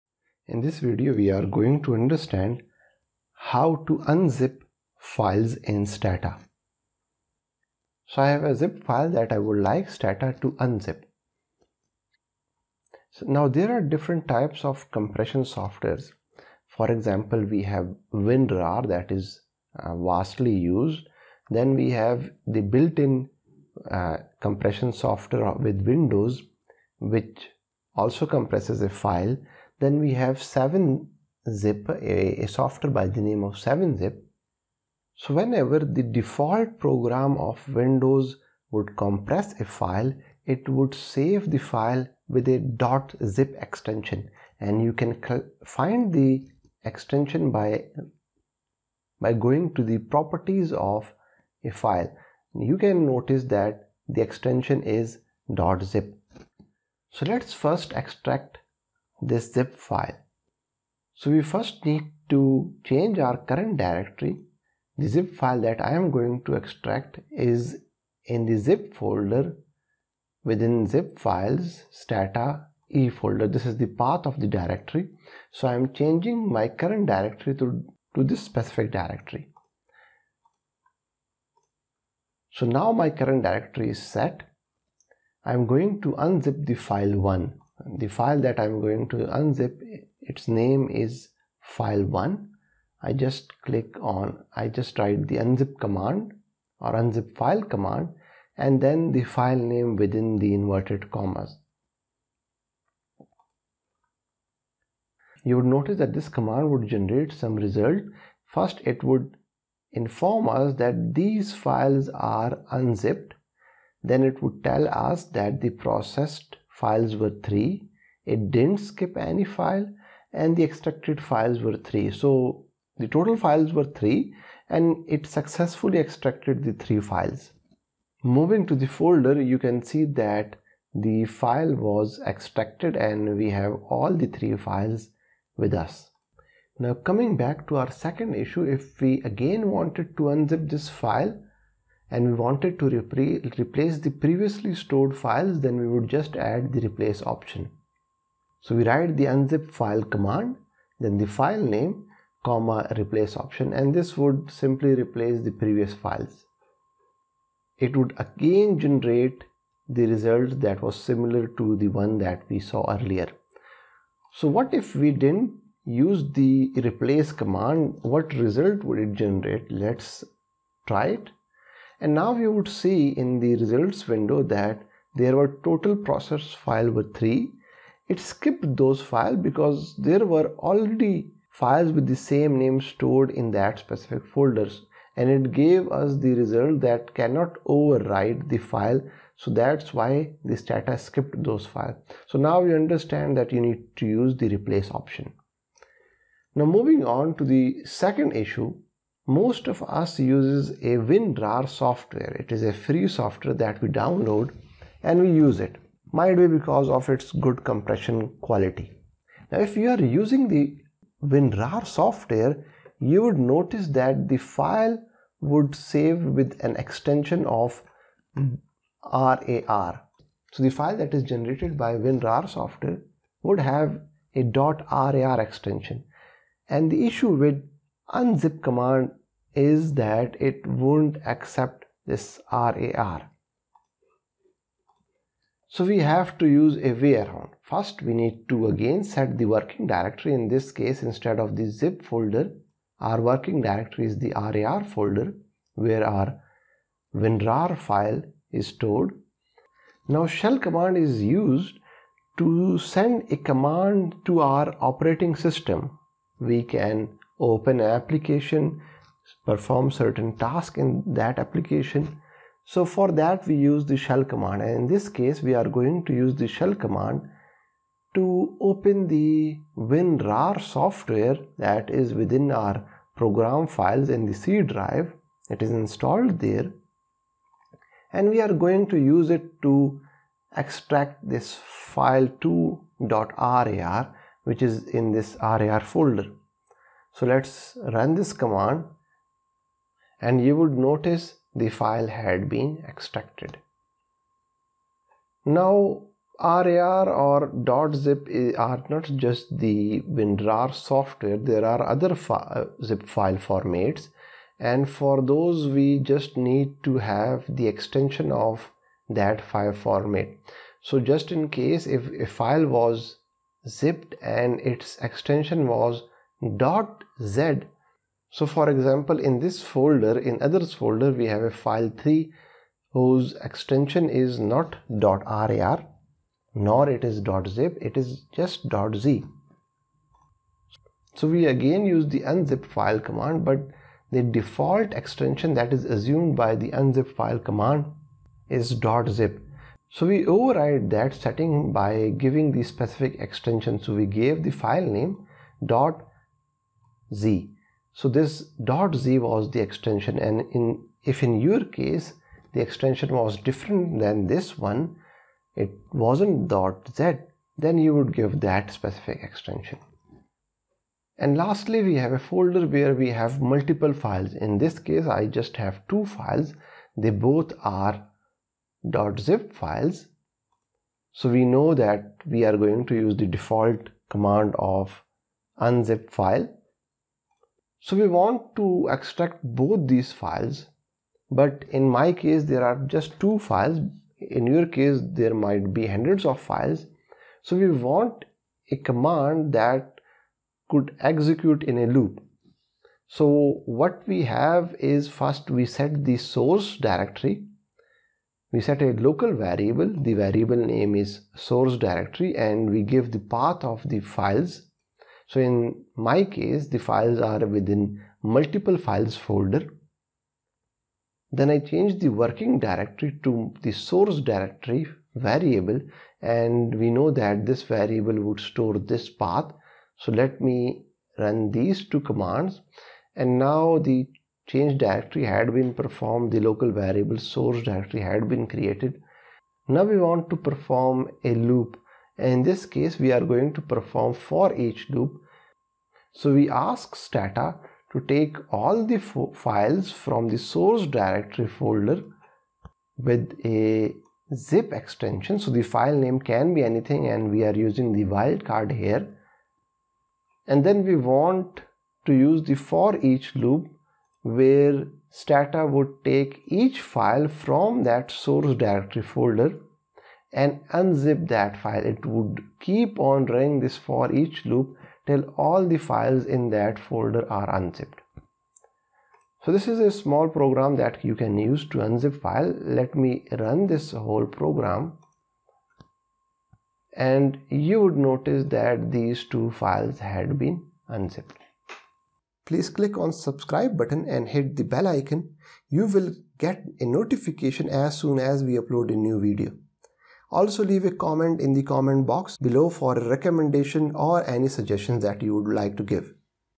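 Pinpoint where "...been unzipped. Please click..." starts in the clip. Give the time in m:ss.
8:00.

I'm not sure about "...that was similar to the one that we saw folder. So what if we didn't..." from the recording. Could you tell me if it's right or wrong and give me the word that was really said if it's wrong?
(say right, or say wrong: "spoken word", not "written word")
wrong: "earlier", not "folder".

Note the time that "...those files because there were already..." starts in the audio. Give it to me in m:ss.
2:58.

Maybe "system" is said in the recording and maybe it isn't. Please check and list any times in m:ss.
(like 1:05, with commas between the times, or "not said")
4:15.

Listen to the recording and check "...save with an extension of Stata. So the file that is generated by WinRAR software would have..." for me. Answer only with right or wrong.
wrong.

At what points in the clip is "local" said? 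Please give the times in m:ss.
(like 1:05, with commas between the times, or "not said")
6:38, 7:06.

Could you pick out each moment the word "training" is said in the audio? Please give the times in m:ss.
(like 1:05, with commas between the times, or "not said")
not said.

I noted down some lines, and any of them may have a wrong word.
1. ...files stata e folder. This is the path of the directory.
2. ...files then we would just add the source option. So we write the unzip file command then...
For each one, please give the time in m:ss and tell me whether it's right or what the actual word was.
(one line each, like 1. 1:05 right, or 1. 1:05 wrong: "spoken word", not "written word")
1. 1:11 right
2. 2:25 wrong: "replace", not "source".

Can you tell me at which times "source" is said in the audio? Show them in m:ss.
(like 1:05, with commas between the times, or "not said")
6:36, 6:41, 6:53, 7:07, 7:20, 7:38.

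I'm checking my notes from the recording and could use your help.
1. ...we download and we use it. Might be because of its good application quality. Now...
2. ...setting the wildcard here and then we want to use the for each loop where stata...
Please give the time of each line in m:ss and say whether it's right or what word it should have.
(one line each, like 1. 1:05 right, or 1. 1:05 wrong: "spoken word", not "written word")
1. 3:23 wrong: "compression", not "application"
2. 7:27 wrong: "using", not "setting".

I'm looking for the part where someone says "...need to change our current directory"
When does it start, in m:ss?
1:01.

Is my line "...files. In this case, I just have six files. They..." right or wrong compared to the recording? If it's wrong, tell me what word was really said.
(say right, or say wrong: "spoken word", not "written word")
wrong: "two", not "six".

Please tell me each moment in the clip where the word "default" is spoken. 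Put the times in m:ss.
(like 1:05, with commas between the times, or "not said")
0:36, 5:34, 6:13.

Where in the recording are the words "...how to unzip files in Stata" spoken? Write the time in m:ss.
0:03.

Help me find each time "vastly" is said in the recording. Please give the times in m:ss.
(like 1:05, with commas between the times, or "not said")
0:19.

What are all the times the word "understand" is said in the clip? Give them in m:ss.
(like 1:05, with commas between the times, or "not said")
0:01, 3:12.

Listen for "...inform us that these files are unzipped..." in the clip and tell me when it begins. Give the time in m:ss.
1:49.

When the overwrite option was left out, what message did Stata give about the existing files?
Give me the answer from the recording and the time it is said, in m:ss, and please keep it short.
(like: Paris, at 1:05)
cannot overwrite the file, at 3:07.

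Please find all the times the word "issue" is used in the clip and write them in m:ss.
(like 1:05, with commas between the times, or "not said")
2:18, 3:18, 3:47.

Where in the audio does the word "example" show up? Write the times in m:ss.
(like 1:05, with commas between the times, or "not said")
0:16, 5:18.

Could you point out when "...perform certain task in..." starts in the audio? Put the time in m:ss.
4:19.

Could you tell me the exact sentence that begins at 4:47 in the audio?
So let's run this command and you would notice the file had been extracted.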